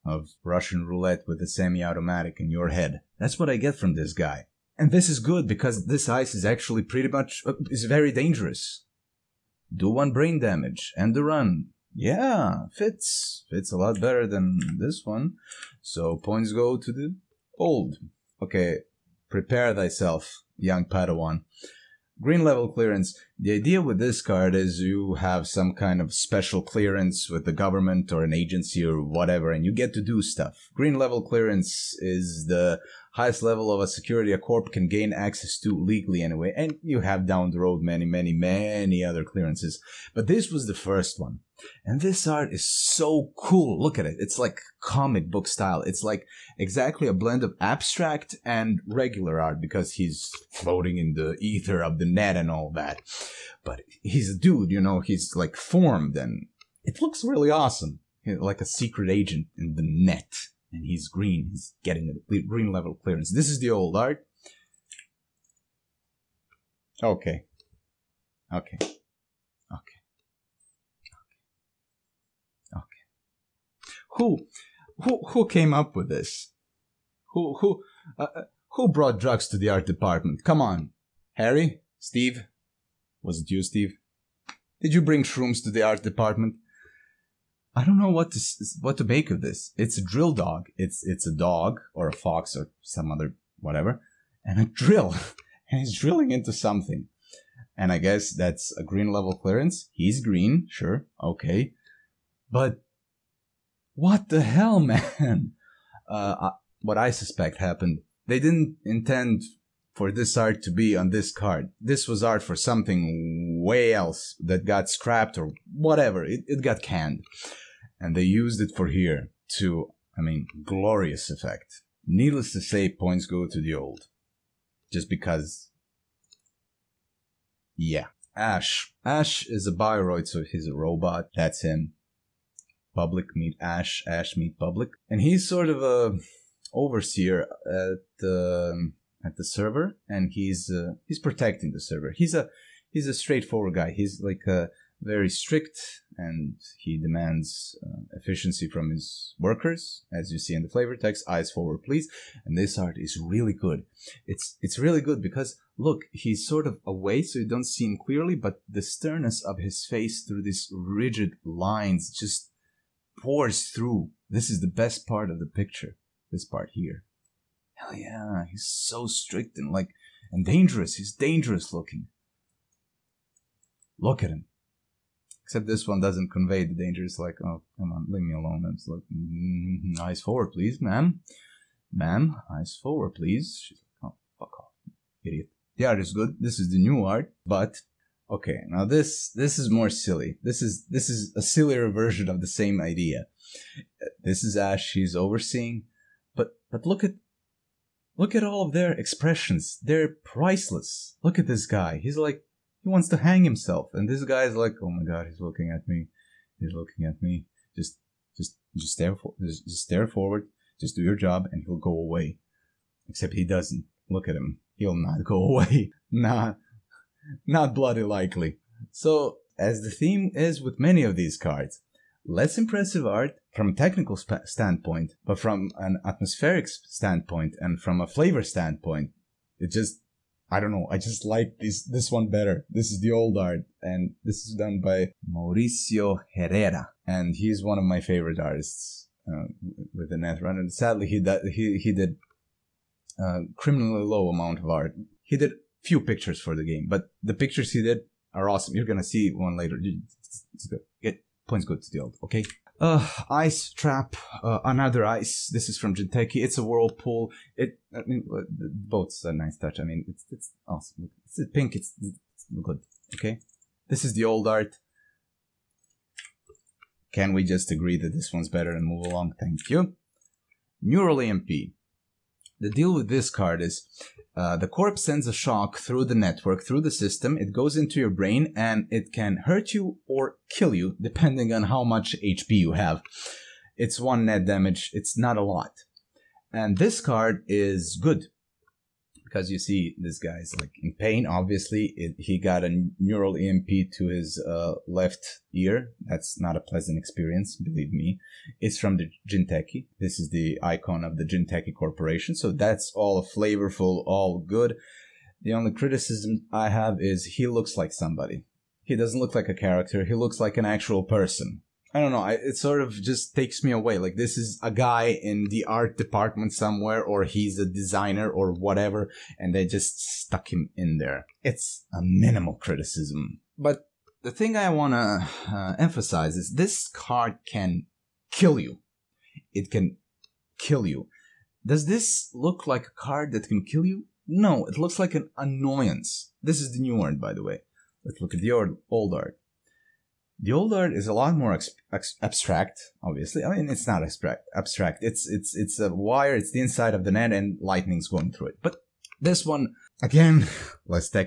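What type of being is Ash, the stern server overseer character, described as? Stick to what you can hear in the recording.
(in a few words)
Bioroid.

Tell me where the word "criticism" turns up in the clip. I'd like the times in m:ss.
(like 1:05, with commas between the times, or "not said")
5:05, 5:22.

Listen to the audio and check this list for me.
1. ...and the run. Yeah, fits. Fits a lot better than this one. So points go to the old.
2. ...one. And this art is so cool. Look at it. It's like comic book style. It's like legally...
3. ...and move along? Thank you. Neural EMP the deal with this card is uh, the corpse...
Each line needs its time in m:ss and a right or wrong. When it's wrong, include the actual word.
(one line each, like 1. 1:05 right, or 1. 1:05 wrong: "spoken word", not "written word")
1. 0:10 right
2. 0:41 wrong: "exactly", not "legally"
3. 4:28 right.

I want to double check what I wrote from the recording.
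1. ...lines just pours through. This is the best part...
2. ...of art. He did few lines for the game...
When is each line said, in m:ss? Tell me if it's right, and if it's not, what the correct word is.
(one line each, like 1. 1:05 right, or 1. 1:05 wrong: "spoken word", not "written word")
1. 2:41 right
2. 4:04 wrong: "pictures", not "lines".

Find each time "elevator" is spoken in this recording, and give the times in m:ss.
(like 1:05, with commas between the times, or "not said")
not said.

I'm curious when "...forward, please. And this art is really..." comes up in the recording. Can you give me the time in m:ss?
2:31.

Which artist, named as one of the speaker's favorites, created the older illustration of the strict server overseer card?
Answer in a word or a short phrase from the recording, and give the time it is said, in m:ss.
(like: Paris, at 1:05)
Mauricio Herrera, at 3:55.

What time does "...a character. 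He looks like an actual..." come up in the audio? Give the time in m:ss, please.
5:09.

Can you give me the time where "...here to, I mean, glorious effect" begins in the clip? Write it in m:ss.
1:58.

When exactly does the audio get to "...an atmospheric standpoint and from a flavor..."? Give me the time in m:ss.
3:45.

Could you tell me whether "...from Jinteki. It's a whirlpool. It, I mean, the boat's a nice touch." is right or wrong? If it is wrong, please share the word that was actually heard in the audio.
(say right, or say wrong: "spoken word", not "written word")
right.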